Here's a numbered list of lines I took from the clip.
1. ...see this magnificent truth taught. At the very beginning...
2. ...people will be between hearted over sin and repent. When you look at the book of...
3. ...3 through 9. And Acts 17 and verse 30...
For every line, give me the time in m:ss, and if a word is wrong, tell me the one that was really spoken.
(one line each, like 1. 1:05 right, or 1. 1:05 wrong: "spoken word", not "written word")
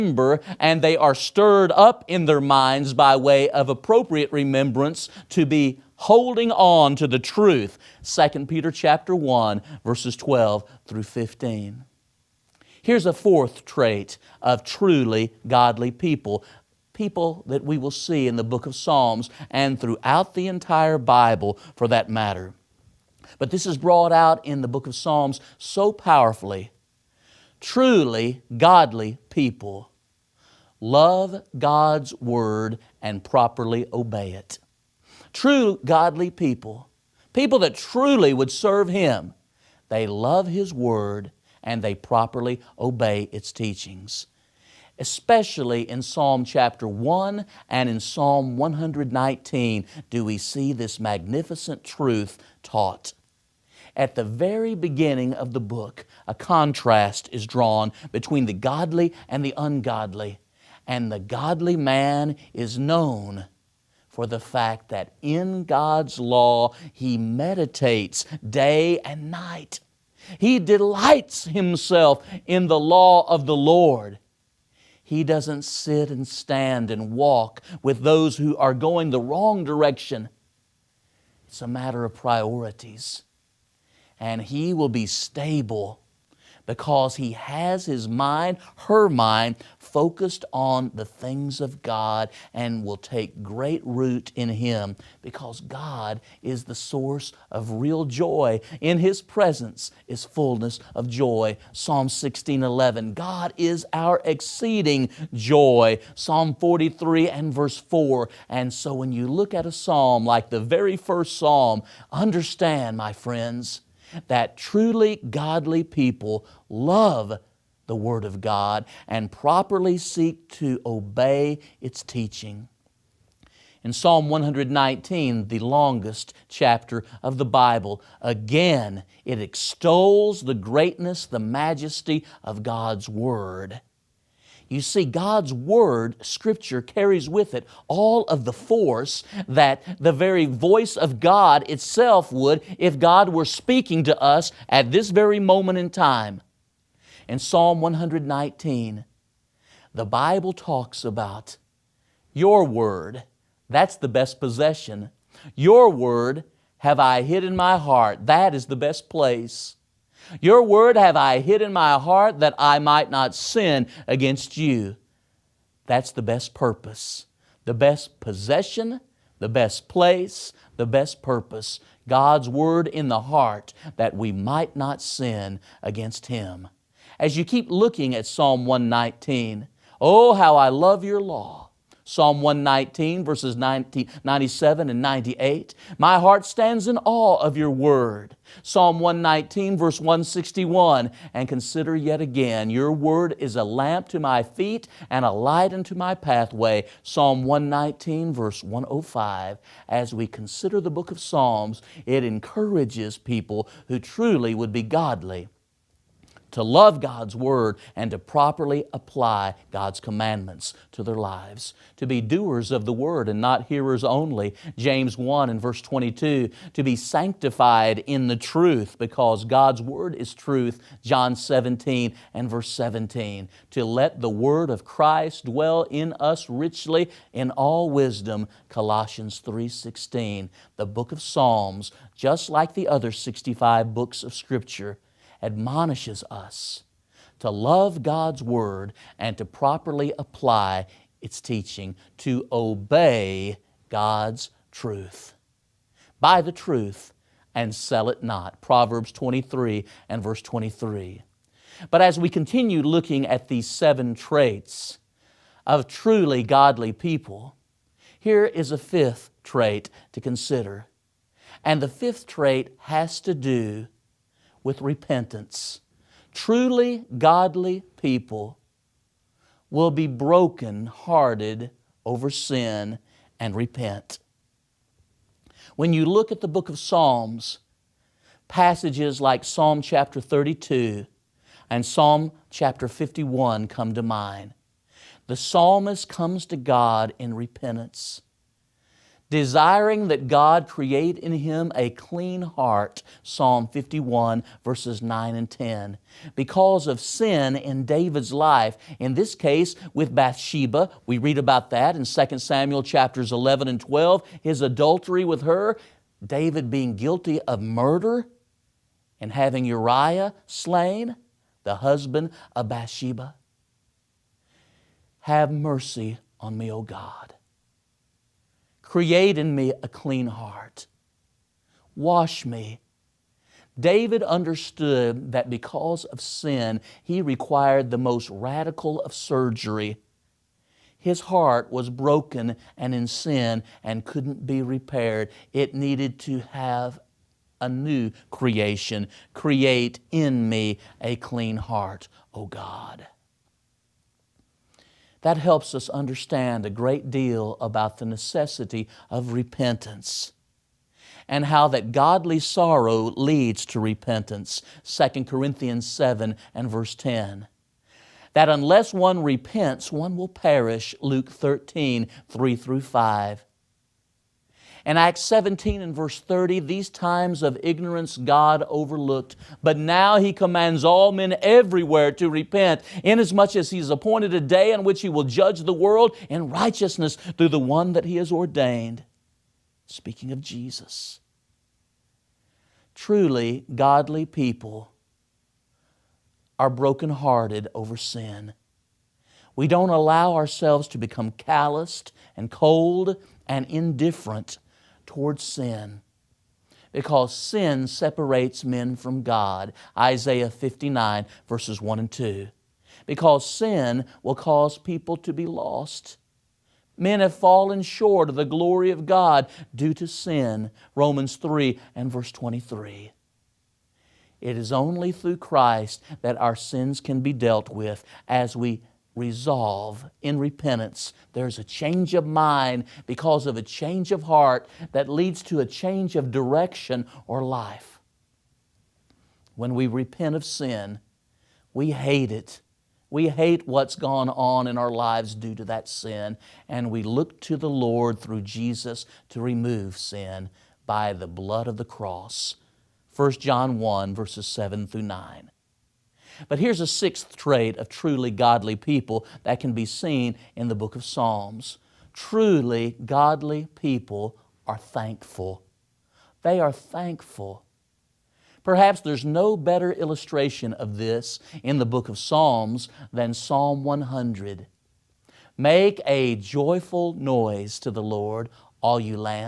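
1. 0:50 right
2. 4:28 wrong: "broken", not "between"
3. 6:02 wrong: "5", not "9".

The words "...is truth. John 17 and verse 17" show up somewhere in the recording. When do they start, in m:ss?
3:40.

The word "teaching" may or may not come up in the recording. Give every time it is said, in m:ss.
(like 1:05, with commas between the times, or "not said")
0:43, 2:02, 4:01.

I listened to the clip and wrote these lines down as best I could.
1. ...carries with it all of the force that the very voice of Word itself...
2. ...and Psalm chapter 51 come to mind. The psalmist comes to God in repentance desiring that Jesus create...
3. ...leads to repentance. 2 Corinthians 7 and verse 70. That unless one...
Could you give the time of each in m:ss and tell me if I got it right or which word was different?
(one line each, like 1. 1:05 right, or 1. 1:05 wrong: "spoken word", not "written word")
1. 2:16 wrong: "God", not "Word"
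2. 4:41 wrong: "God", not "Jesus"
3. 5:53 wrong: "10", not "70".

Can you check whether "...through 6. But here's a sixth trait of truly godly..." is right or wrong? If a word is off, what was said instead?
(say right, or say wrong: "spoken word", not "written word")
wrong: "9", not "6".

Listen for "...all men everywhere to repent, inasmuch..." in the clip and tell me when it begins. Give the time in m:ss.
6:10.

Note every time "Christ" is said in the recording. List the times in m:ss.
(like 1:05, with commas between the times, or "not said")
3:44, 6:55.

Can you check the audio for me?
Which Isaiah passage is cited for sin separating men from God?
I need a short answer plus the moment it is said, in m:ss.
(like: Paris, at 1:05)
Isaiah 59:1-2, at 6:39.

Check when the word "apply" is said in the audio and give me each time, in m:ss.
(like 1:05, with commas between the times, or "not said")
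3:28, 4:00.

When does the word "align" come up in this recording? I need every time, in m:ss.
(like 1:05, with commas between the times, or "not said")
not said.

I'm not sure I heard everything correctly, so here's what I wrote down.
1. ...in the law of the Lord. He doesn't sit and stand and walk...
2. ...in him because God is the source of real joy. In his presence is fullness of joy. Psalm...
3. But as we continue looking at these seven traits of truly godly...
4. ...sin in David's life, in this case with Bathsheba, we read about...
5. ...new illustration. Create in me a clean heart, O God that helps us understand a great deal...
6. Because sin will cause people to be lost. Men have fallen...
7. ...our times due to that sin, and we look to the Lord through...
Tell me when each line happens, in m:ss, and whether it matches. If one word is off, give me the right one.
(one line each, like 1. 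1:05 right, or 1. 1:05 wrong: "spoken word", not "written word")
1. 1:12 right
2. 1:34 right
3. 4:11 right
4. 4:57 right
5. 5:37 wrong: "creation", not "illustration"
6. 6:43 right
7. 7:14 wrong: "lives", not "times".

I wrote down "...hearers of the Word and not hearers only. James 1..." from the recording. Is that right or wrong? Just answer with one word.
wrong.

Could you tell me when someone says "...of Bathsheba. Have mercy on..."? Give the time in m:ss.
5:12.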